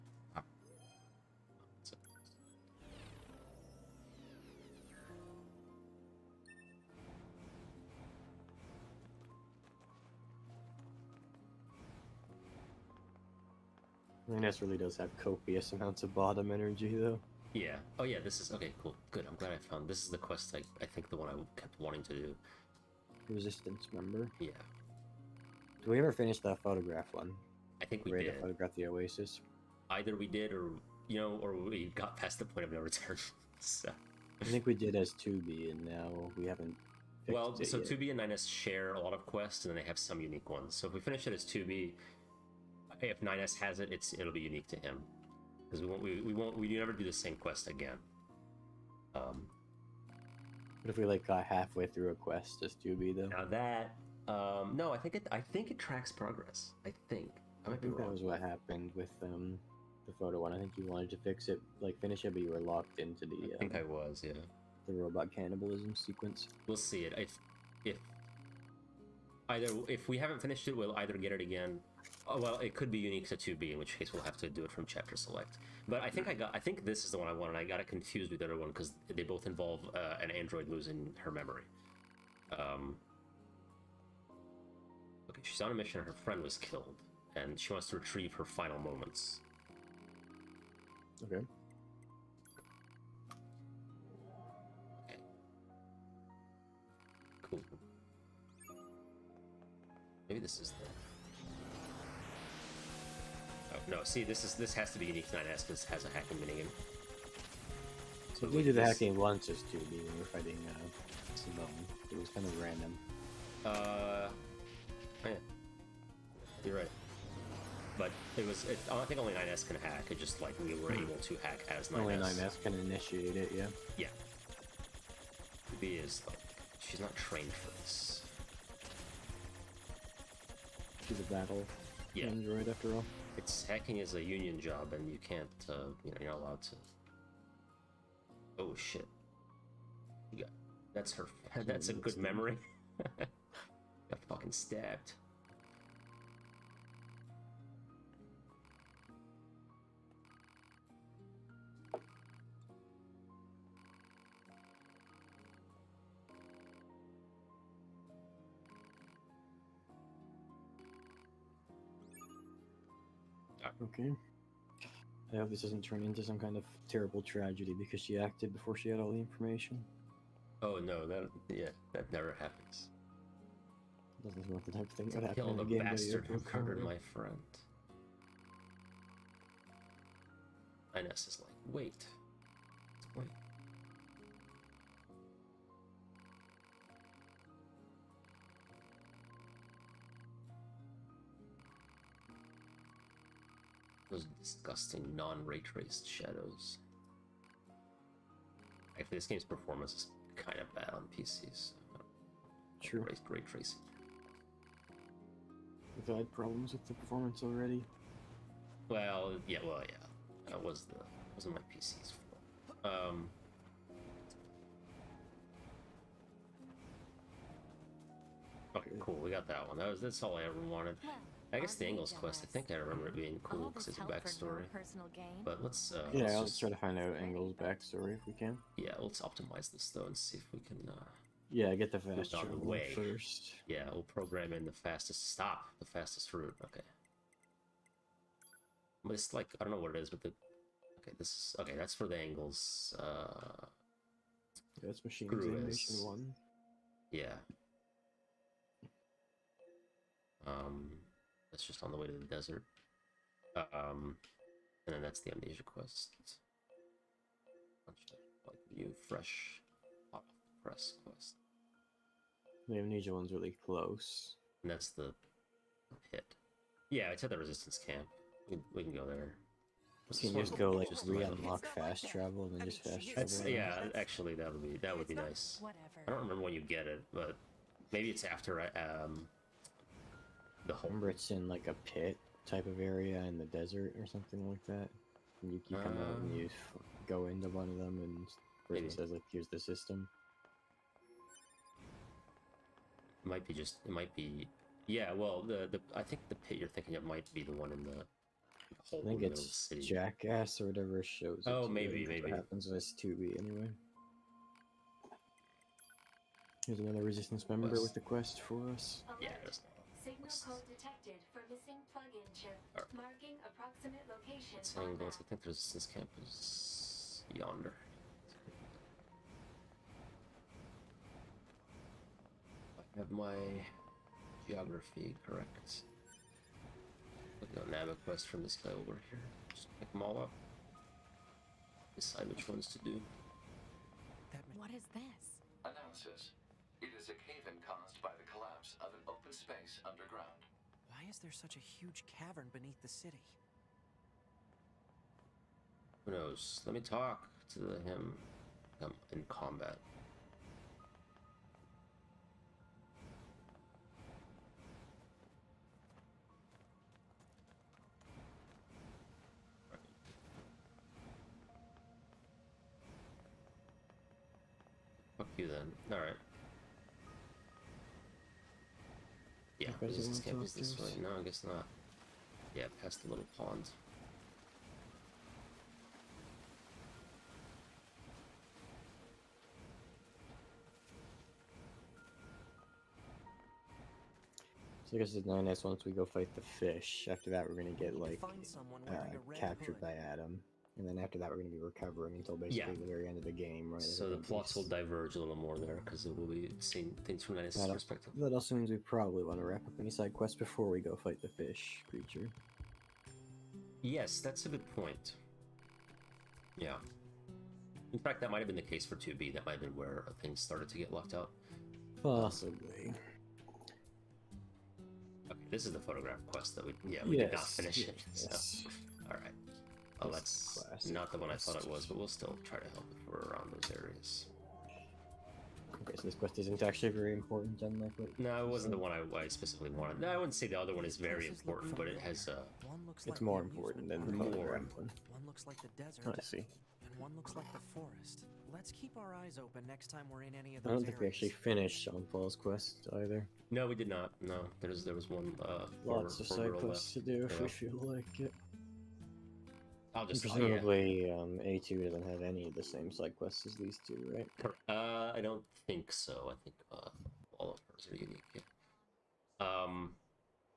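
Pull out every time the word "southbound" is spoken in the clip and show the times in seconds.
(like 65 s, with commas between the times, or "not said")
not said.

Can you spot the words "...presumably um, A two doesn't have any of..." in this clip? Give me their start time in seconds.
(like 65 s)
450 s.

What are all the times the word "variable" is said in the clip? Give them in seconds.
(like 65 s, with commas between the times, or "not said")
not said.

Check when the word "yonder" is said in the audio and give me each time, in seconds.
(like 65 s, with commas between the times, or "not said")
317 s.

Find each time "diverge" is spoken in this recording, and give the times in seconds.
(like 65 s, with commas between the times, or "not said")
394 s.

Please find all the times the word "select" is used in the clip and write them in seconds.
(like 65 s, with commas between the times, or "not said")
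75 s.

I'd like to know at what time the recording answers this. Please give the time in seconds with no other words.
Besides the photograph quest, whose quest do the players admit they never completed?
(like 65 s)
441 s.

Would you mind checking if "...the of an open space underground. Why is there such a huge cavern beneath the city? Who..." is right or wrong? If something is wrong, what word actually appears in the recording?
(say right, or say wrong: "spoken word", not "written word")
right.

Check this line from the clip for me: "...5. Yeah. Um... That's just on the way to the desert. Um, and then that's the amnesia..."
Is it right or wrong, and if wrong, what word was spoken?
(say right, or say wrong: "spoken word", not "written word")
wrong: "1", not "5".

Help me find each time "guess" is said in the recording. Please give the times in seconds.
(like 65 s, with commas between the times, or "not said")
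221 s, 371 s, 384 s.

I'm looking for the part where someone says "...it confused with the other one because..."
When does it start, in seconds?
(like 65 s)
77 s.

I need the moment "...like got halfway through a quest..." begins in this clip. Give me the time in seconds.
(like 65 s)
51 s.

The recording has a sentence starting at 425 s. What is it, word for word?
Okay, so this quest isn't actually very important, then, like what No, it wasn't the one I, I, specifically wanted.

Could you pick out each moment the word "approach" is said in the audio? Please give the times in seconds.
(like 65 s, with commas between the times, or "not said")
not said.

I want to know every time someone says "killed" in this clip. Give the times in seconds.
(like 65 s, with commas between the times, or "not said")
86 s, 175 s.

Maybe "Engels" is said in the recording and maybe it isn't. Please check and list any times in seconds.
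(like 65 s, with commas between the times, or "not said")
221 s, 227 s, 242 s.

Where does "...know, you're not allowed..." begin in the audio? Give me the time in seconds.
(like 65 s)
136 s.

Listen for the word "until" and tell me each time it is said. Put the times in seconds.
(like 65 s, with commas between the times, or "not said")
392 s.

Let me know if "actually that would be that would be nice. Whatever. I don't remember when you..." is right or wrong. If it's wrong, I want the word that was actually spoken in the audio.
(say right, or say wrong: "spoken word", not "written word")
right.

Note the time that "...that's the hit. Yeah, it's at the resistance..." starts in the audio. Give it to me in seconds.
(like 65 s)
264 s.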